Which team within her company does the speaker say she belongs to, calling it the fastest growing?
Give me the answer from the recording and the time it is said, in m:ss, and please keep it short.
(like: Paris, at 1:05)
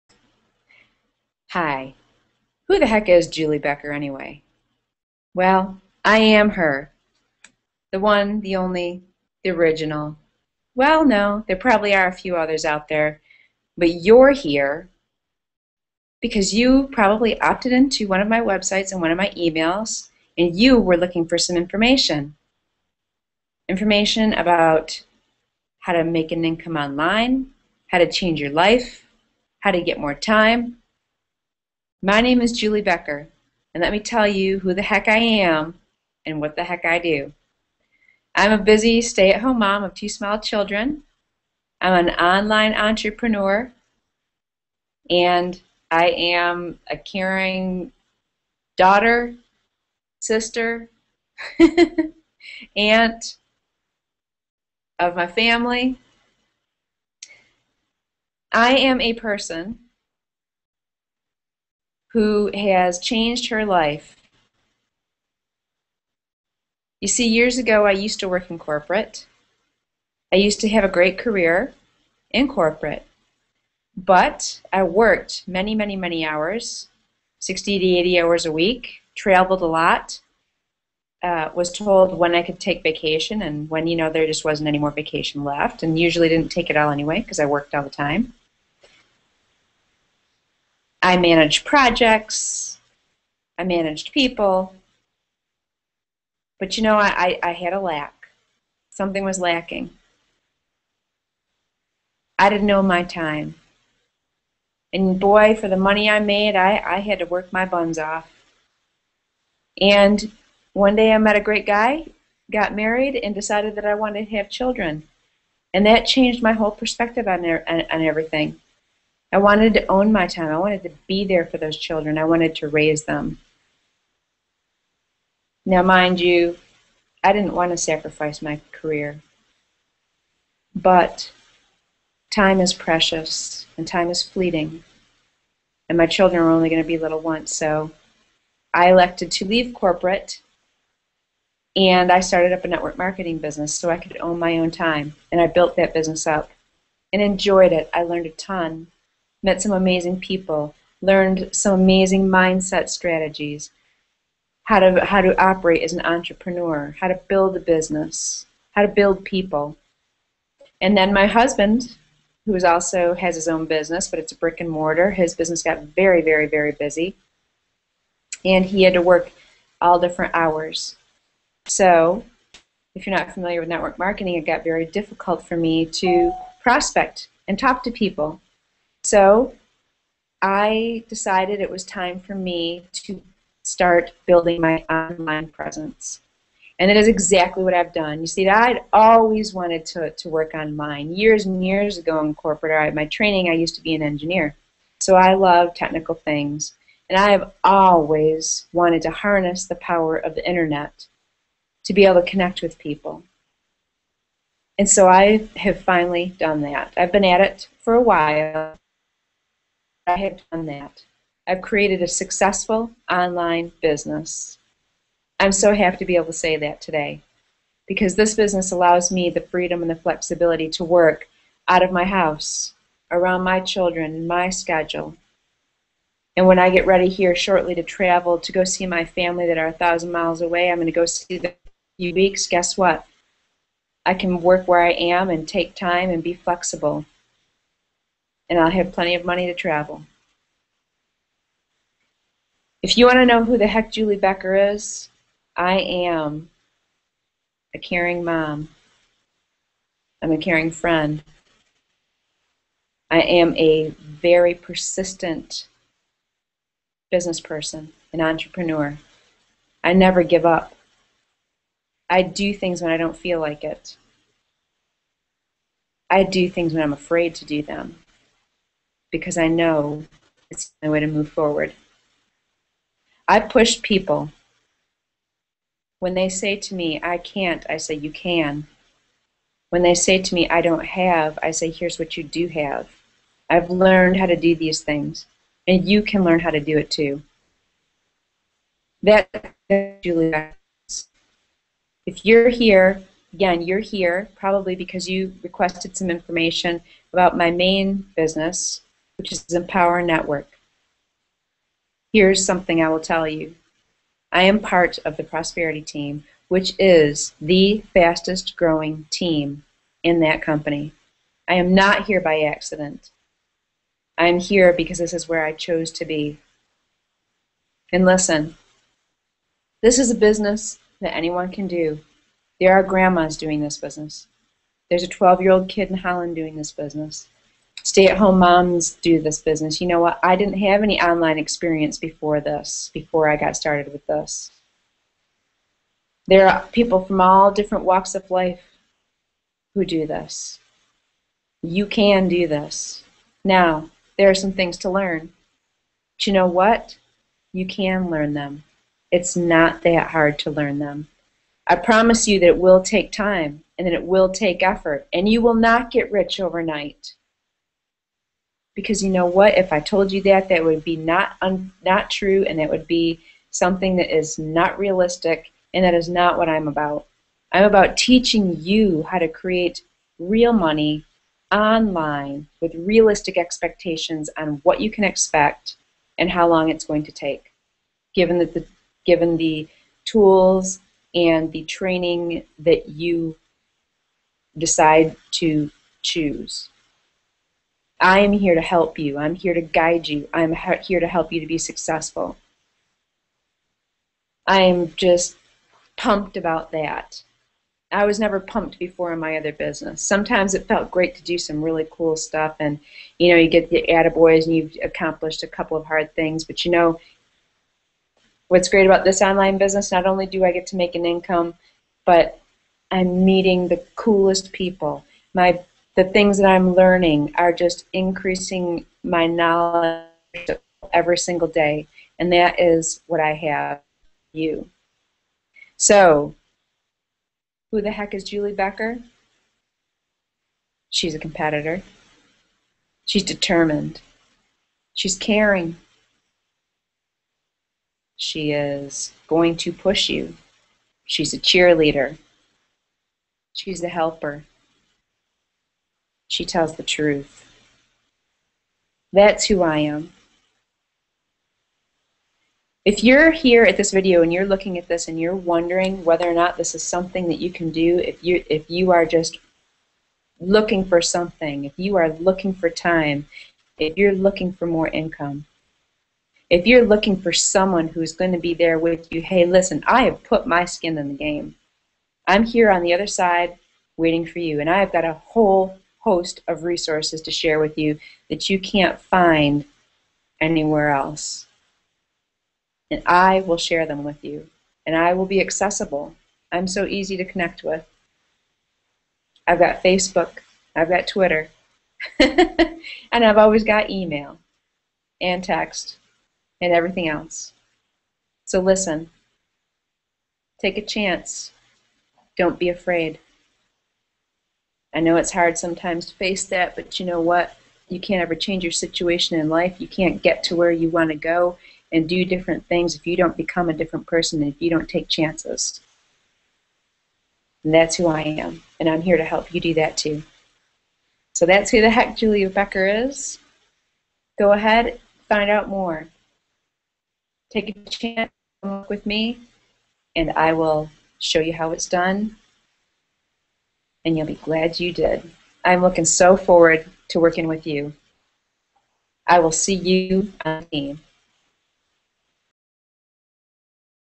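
Prosperity team, at 5:05.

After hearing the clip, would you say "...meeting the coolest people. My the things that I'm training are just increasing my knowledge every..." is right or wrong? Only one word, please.
wrong.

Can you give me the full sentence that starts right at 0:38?
I'm a busy stay at home mom of two small children.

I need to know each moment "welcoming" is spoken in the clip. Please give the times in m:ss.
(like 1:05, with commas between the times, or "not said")
not said.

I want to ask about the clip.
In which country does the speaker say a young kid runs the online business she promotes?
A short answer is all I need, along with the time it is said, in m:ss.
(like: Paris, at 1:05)
Holland, at 5:25.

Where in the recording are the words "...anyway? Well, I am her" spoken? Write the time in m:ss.
0:03.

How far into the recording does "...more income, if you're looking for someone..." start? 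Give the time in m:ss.
7:44.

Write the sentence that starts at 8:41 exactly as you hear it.
So that's who the heck Julie Becker is.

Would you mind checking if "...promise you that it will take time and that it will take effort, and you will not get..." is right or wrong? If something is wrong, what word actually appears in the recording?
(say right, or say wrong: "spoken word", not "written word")
right.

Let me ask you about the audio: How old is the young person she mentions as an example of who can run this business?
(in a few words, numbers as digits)
12.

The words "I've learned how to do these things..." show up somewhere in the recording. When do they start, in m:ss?
4:43.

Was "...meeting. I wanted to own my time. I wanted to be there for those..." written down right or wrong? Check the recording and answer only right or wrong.
wrong.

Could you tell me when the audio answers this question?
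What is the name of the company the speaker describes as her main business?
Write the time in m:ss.
4:59.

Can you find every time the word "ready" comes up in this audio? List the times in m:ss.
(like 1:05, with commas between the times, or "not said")
3:46.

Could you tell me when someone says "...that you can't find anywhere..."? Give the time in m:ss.
7:58.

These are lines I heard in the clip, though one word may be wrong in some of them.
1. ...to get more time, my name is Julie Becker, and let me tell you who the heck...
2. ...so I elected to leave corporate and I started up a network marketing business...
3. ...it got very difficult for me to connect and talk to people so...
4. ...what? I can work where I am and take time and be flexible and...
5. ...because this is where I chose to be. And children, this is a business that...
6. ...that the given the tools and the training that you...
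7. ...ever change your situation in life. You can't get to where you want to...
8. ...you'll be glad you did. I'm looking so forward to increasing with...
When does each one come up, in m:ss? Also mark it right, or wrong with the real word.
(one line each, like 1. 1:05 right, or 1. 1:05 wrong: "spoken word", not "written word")
1. 0:29 right
2. 2:17 right
3. 2:54 wrong: "prospect", not "connect"
4. 3:52 right
5. 5:14 wrong: "listen", not "children"
6. 6:18 right
7. 8:28 right
8. 8:54 wrong: "working", not "increasing".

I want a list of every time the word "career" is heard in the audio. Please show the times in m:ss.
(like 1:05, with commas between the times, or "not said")
1:11, 2:08.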